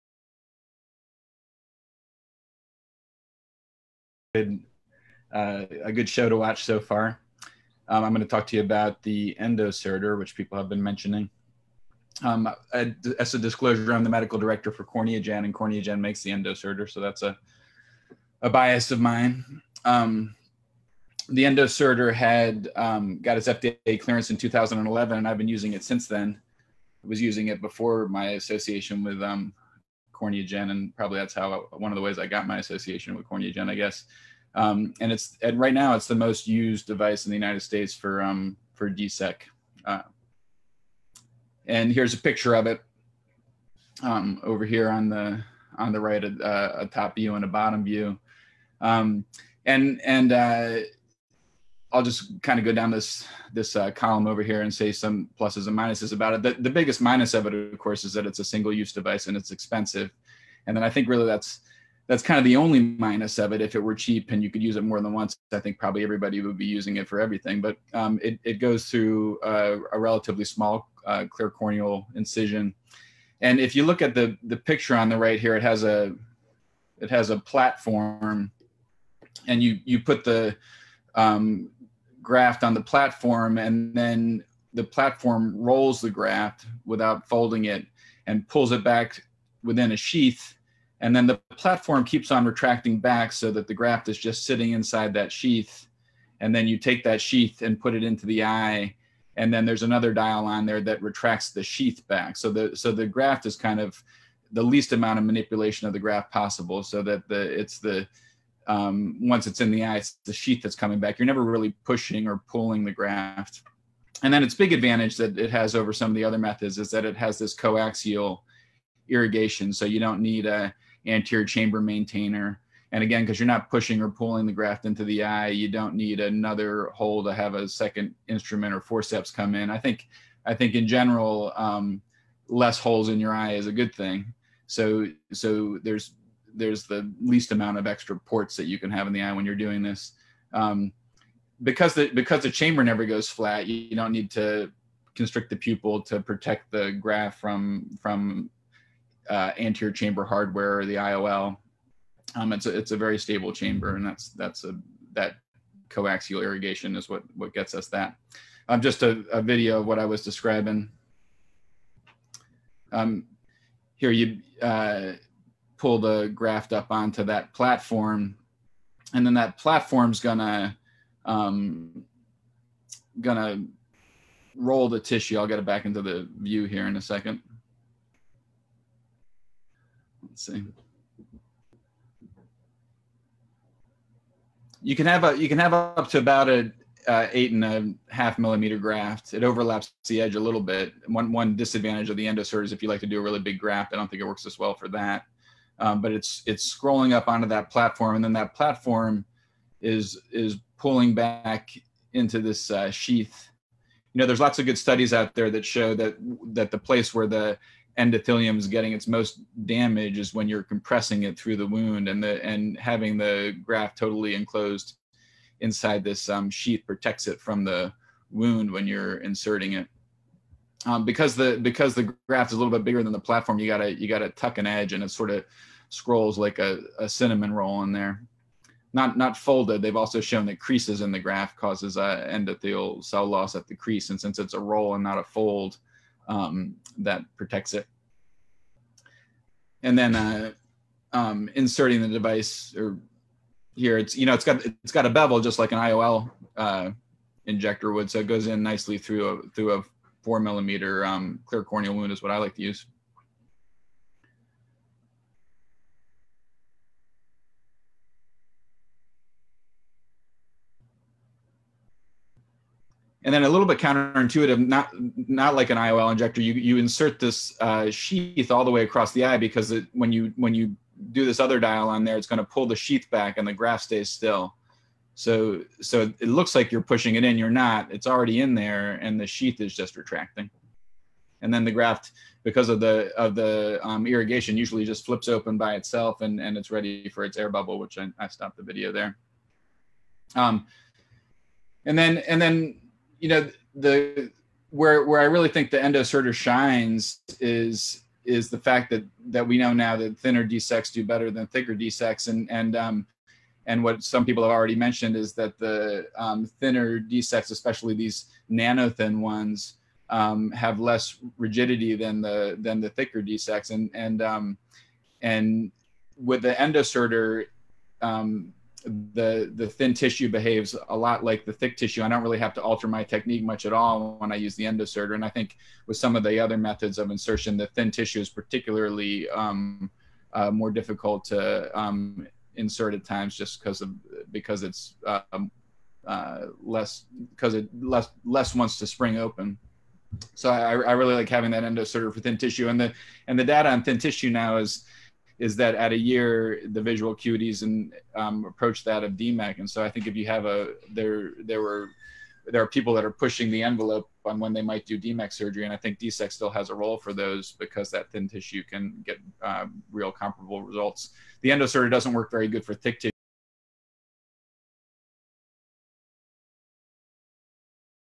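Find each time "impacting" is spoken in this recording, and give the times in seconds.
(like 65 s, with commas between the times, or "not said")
not said.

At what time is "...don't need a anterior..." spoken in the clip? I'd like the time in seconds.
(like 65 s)
119 s.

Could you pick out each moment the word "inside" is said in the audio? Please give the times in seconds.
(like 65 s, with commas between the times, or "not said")
94 s, 215 s.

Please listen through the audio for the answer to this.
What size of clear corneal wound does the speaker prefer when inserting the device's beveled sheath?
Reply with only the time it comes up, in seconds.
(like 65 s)
250 s.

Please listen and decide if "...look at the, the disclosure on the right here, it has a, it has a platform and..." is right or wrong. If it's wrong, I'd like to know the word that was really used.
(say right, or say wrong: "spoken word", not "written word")
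wrong: "picture", not "disclosure".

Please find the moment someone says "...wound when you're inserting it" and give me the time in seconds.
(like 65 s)
218 s.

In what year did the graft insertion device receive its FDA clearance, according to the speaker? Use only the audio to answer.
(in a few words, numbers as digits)
2011.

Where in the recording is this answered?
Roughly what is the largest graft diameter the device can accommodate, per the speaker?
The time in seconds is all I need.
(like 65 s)
187 s.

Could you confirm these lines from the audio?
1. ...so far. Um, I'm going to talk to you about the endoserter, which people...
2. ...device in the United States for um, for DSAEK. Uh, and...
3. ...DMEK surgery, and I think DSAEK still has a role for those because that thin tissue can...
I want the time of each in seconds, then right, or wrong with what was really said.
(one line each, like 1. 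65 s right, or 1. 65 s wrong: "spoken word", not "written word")
1. 6 s right
2. 36 s right
3. 354 s right.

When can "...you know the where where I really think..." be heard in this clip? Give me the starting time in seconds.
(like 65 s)
293 s.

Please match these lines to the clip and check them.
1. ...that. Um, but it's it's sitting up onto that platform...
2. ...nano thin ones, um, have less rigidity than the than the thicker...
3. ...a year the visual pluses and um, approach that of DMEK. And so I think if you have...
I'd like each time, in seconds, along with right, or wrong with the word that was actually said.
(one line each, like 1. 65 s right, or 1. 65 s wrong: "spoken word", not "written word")
1. 194 s wrong: "scrolling", not "sitting"
2. 308 s right
3. 345 s wrong: "acuities", not "pluses".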